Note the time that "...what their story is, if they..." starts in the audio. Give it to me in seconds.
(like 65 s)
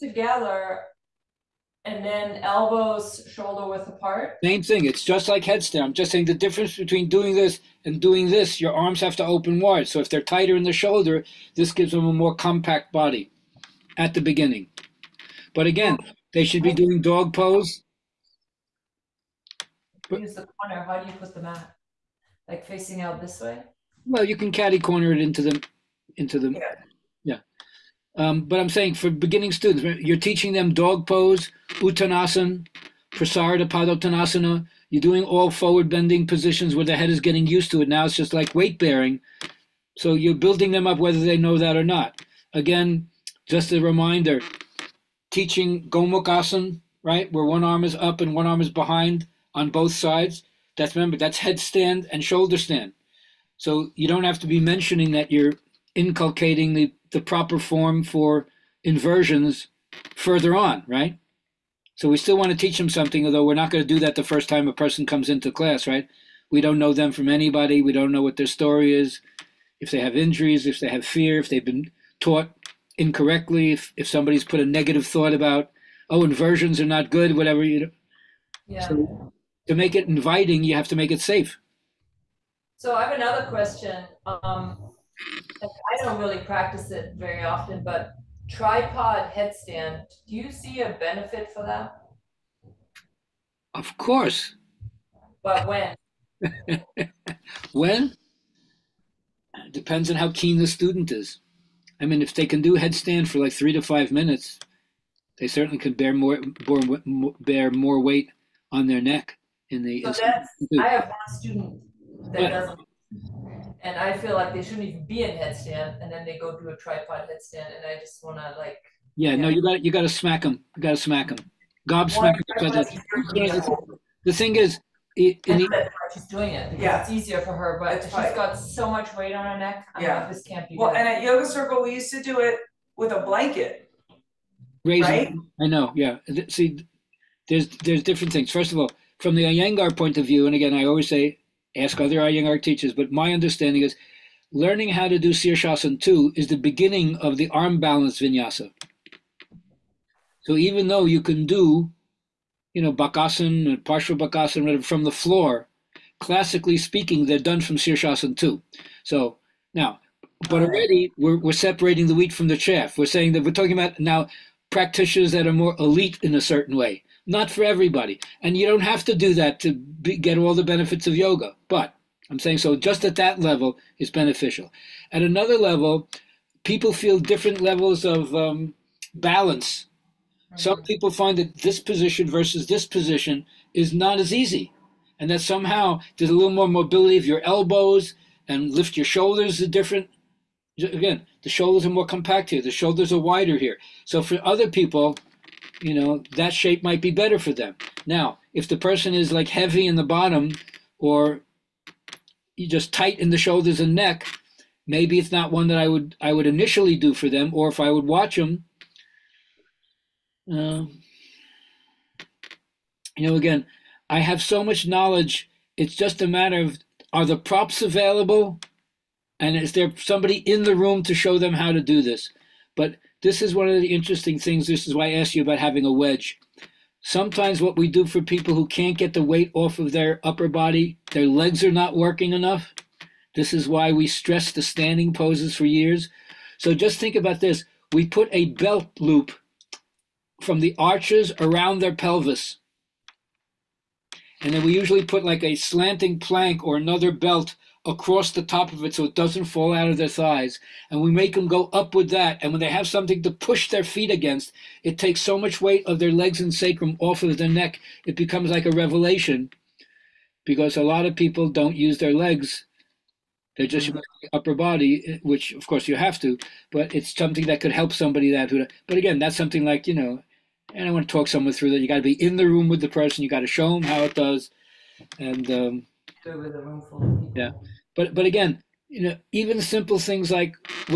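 68 s.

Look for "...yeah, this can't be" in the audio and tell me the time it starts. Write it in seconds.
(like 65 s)
130 s.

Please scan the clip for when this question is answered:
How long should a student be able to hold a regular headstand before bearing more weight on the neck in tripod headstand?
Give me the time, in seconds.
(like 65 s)
103 s.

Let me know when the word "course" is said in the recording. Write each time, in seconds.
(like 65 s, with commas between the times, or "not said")
93 s, 265 s.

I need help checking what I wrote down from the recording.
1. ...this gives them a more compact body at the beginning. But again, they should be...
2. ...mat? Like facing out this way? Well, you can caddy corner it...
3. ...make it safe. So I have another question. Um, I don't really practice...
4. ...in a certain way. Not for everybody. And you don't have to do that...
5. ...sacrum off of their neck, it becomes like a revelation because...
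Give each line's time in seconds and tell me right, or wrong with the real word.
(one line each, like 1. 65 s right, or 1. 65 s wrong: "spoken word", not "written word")
1. 11 s right
2. 21 s right
3. 80 s right
4. 166 s right
5. 256 s right.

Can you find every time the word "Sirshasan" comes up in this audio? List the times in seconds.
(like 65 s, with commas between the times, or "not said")
145 s, 157 s.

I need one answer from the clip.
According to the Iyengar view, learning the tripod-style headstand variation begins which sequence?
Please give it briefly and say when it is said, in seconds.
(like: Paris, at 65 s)
arm balance vinyasa, at 147 s.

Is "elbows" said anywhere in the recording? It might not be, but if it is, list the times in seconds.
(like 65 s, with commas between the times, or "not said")
2 s, 187 s.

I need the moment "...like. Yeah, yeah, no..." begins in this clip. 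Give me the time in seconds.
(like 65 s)
118 s.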